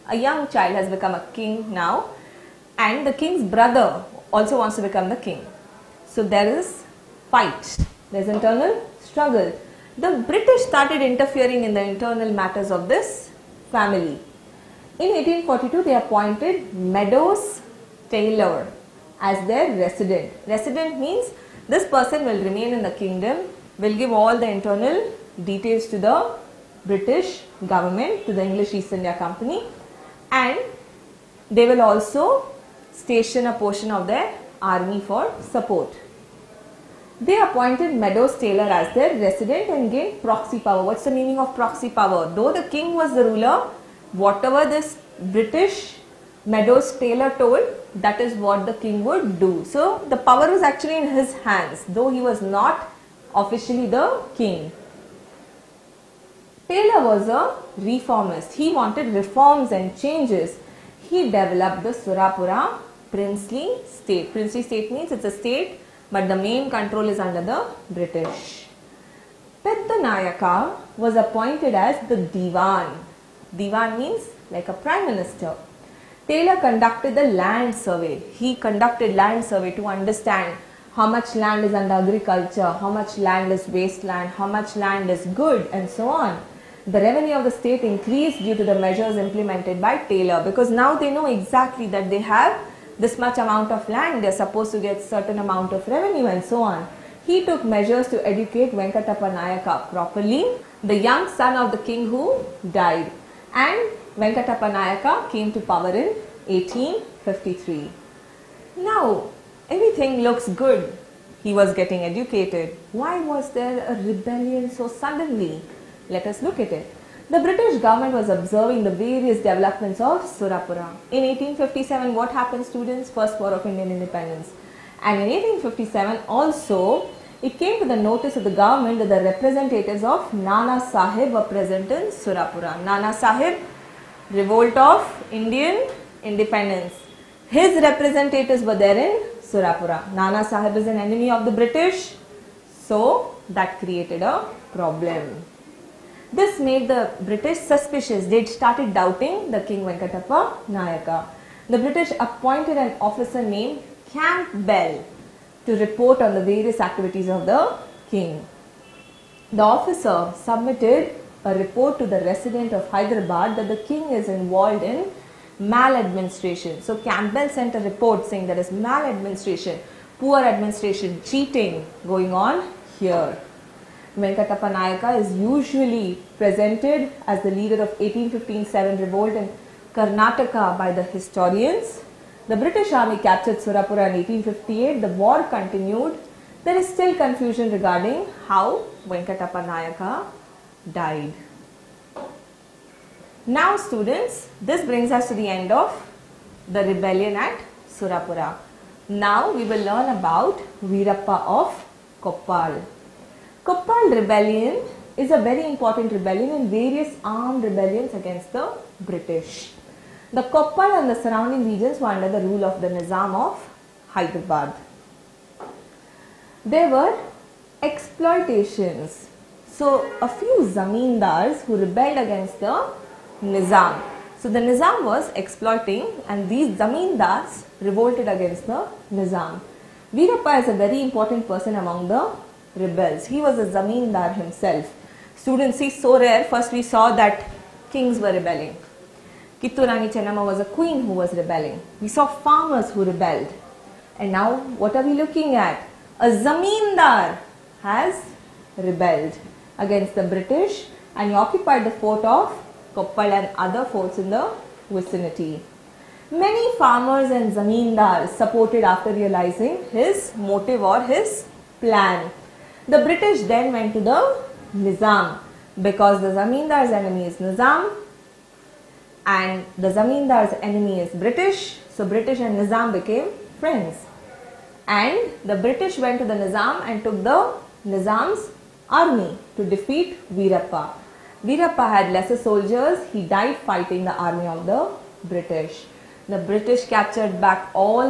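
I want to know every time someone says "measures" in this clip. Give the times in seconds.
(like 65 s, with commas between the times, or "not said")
88 s, 97 s.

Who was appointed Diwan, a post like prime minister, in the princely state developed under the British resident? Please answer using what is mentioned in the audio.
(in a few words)
Pedanayaka.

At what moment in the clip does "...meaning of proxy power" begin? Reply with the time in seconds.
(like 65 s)
41 s.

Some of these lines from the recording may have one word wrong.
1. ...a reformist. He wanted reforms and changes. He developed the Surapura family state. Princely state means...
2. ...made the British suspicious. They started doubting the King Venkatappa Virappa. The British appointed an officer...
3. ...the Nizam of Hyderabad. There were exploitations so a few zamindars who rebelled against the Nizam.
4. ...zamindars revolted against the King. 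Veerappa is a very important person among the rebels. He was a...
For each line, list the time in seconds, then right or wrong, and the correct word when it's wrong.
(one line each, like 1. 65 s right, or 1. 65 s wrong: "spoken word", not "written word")
1. 57 s wrong: "princely", not "family"
2. 146 s wrong: "Nayaka", not "Virappa"
3. 212 s right
4. 226 s wrong: "Nizam", not "King".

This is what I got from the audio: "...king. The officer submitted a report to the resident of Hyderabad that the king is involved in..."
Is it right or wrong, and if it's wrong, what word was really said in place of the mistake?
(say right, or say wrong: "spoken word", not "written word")
right.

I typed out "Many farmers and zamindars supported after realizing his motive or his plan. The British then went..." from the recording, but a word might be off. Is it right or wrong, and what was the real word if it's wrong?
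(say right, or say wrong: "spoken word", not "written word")
right.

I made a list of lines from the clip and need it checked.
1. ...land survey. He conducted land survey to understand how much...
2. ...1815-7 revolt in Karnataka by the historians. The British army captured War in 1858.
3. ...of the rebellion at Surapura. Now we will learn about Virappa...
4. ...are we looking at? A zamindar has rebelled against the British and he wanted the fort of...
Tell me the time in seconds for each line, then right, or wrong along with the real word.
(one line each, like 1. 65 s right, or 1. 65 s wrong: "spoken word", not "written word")
1. 77 s right
2. 177 s wrong: "Surapura", not "War"
3. 195 s right
4. 244 s wrong: "occupied", not "wanted".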